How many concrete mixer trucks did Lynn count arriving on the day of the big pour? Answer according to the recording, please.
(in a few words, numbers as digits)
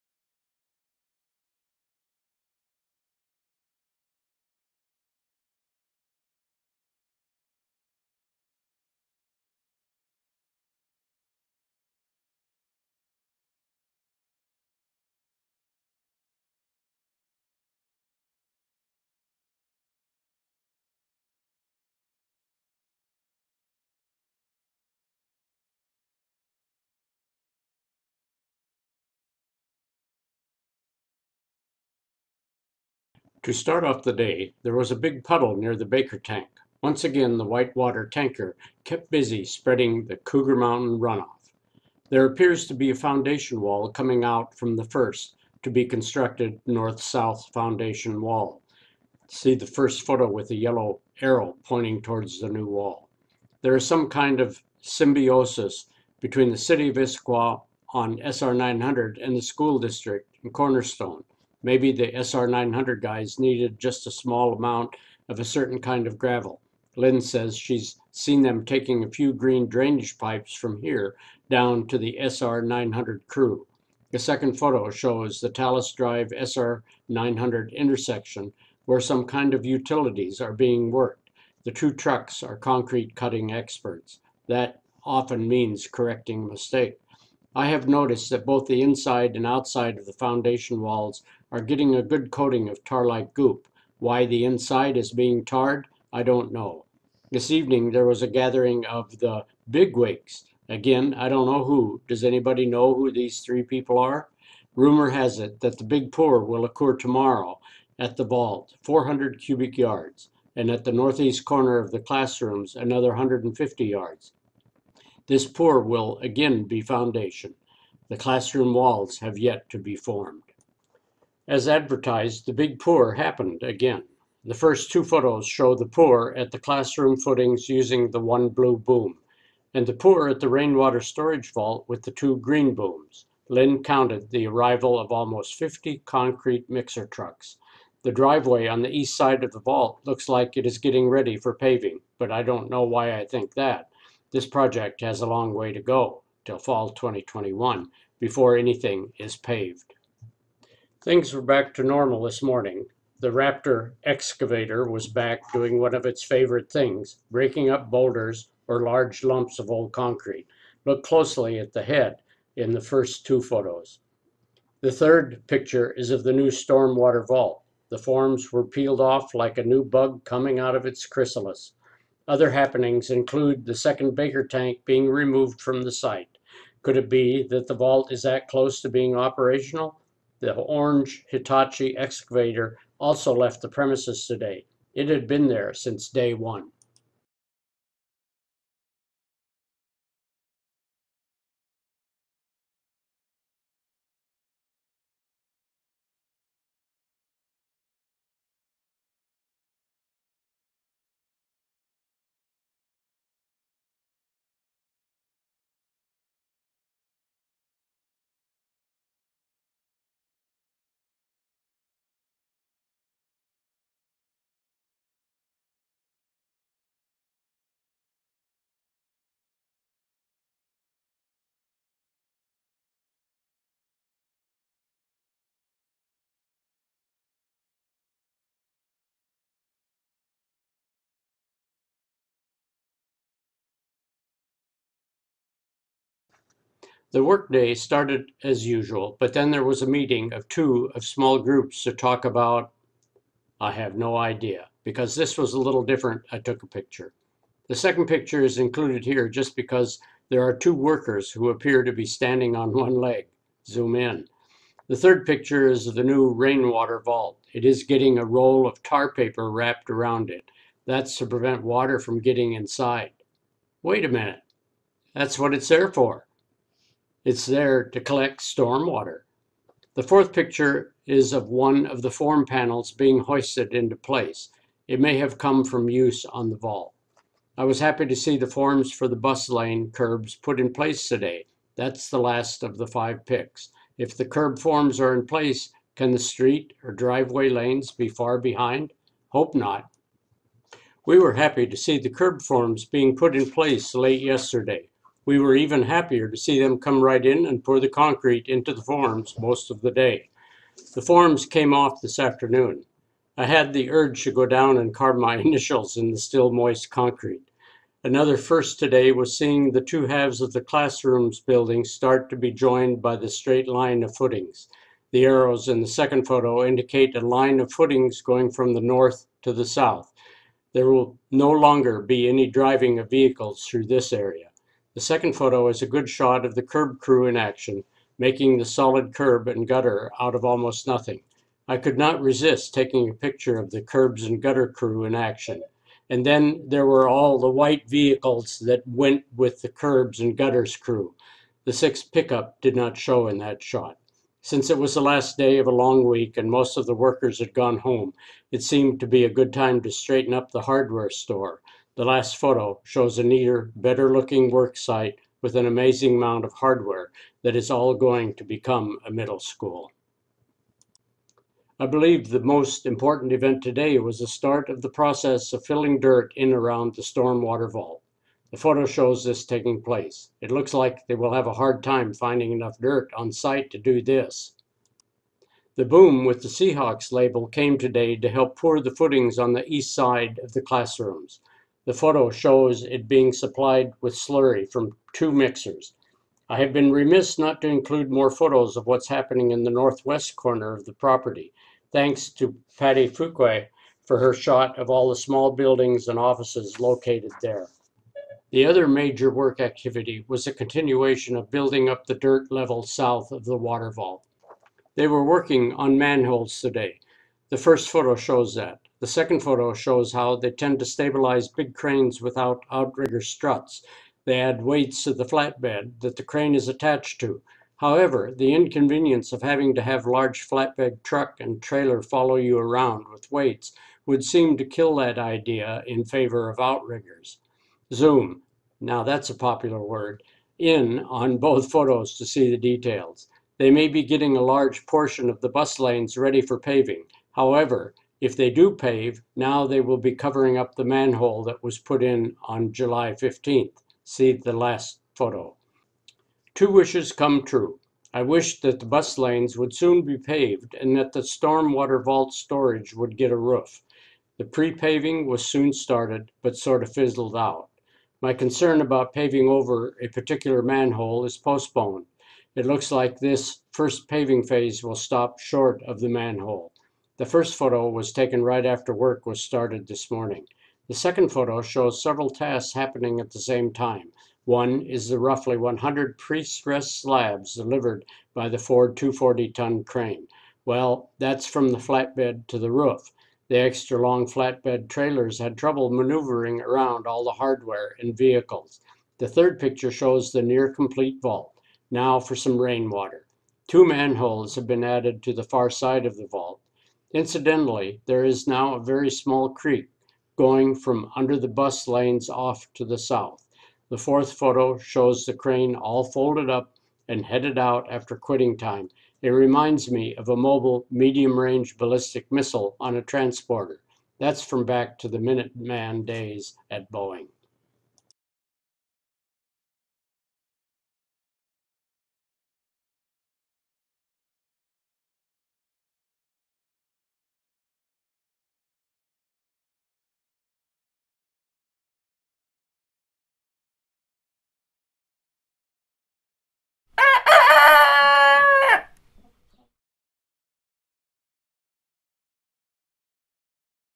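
almost 50.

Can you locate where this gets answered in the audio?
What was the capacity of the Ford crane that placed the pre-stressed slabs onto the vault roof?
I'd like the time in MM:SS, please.
07:58.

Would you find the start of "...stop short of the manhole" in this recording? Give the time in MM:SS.
07:44.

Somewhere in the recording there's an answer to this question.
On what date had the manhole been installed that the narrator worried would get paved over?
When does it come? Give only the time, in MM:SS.
07:22.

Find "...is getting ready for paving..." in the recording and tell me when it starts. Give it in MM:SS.
02:20.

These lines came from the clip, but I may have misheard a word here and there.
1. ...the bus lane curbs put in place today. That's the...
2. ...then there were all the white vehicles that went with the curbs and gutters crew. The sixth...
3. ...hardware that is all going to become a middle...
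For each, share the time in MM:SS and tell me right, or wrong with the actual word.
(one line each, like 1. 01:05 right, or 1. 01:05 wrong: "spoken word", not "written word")
1. 04:39 right
2. 05:36 right
3. 05:56 right.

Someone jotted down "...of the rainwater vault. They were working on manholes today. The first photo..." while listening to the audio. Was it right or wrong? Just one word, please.
wrong.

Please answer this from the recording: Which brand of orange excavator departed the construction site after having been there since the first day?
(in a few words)
Hitachi.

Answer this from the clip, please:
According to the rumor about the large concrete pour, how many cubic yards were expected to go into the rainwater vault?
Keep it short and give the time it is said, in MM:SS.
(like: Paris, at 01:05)
400, at 01:48.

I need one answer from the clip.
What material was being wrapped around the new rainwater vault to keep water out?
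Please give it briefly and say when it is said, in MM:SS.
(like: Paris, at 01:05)
tar paper, at 04:18.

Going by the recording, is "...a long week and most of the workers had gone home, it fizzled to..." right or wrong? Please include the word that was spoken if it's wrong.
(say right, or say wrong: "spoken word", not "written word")
wrong: "seemed", not "fizzled".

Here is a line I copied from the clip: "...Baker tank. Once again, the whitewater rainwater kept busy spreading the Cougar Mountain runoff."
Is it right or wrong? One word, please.
wrong.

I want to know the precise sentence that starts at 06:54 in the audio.
They add weights to the flatbed that the crane is attached to.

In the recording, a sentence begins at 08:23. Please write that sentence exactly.
The fourth photo shows the crane all folded up and headed out after quitting time.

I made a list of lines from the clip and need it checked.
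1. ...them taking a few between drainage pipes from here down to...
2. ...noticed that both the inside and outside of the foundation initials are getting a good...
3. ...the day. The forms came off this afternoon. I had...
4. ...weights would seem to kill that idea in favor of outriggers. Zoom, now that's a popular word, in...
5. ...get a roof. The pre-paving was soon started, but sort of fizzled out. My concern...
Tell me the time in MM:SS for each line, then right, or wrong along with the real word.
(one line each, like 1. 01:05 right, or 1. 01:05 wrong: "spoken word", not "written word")
1. 01:08 wrong: "green", not "between"
2. 01:27 wrong: "walls", not "initials"
3. 04:59 right
4. 07:03 right
5. 07:33 right.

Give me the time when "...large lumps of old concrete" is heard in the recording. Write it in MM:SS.
02:38.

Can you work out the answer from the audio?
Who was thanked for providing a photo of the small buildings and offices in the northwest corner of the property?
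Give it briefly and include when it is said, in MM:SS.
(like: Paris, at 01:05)
Patty Fuque, at 06:32.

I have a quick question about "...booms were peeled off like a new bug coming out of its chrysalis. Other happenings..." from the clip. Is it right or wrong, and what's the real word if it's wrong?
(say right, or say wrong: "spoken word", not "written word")
wrong: "forms", not "booms".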